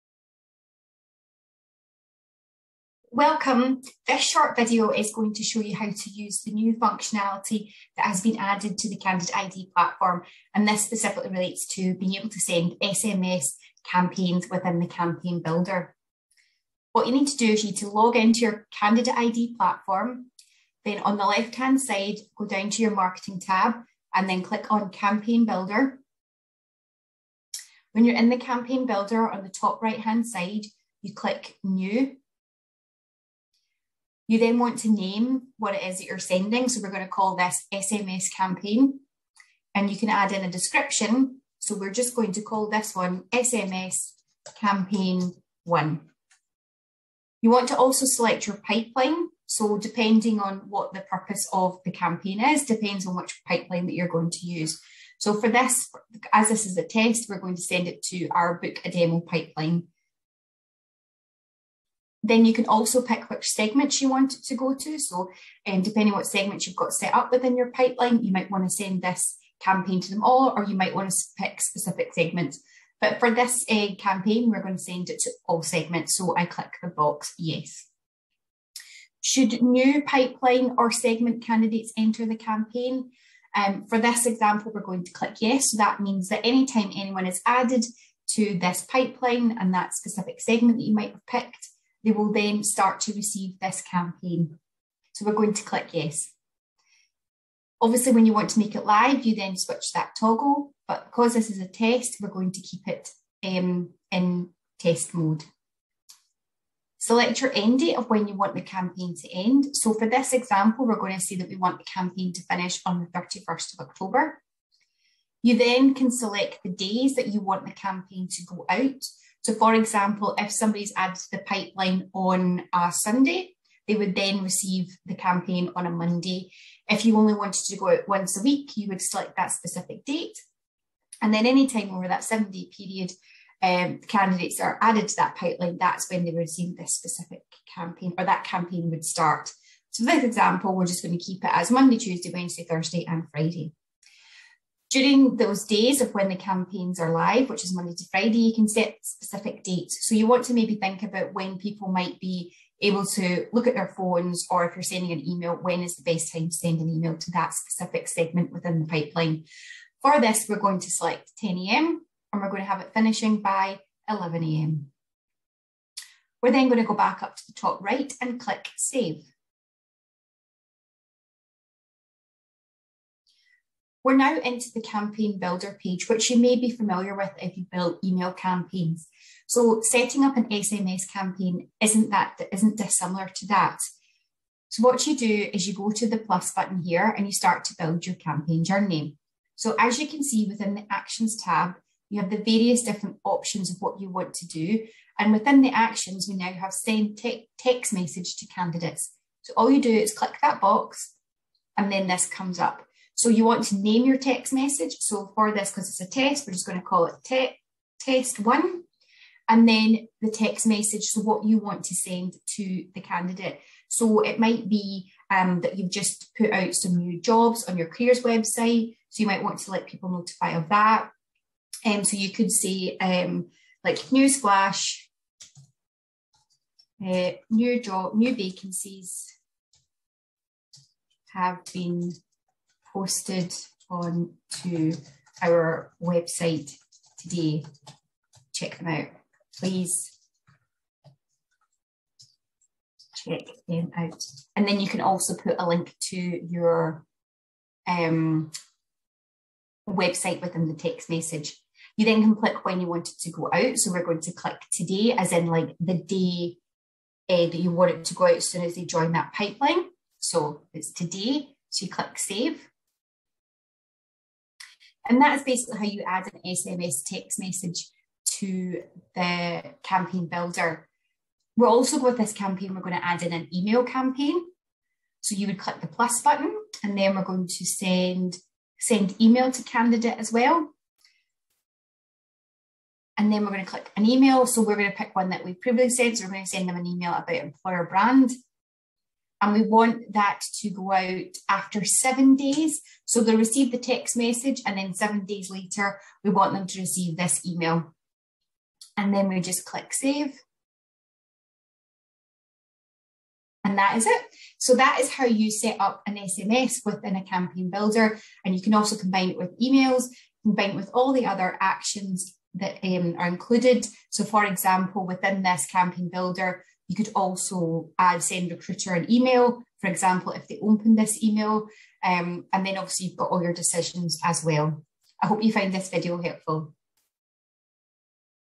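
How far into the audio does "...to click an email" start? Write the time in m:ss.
4:43.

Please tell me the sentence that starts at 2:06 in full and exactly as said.
If you only wanted to go out once a week, you would select that specific date.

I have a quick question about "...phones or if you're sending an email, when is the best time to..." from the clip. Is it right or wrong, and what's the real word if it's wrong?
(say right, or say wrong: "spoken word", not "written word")
right.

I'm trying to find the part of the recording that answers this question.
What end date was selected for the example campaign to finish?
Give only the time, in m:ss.
1:53.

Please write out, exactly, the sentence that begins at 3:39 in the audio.
So you might want to let people notify of that.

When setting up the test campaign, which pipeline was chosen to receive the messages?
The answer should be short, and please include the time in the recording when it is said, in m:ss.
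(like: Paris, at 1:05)
book a demo, at 0:58.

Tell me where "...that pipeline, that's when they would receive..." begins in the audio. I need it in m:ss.
2:15.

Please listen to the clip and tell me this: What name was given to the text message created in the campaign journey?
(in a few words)
test one.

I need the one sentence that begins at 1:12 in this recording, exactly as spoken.
But for this uh, campaign, we're going to send it to all segments.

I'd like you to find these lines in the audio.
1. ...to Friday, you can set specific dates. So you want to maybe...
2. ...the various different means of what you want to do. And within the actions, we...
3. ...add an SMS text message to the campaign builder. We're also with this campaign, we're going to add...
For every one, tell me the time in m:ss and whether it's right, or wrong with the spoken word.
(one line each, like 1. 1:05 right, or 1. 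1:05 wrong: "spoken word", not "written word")
1. 2:27 right
2. 3:12 wrong: "options", not "means"
3. 4:26 right.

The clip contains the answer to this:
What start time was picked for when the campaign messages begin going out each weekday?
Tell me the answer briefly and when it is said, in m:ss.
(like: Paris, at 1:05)
10 a.m., at 2:41.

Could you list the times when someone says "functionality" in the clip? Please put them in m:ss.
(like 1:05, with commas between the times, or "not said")
0:06.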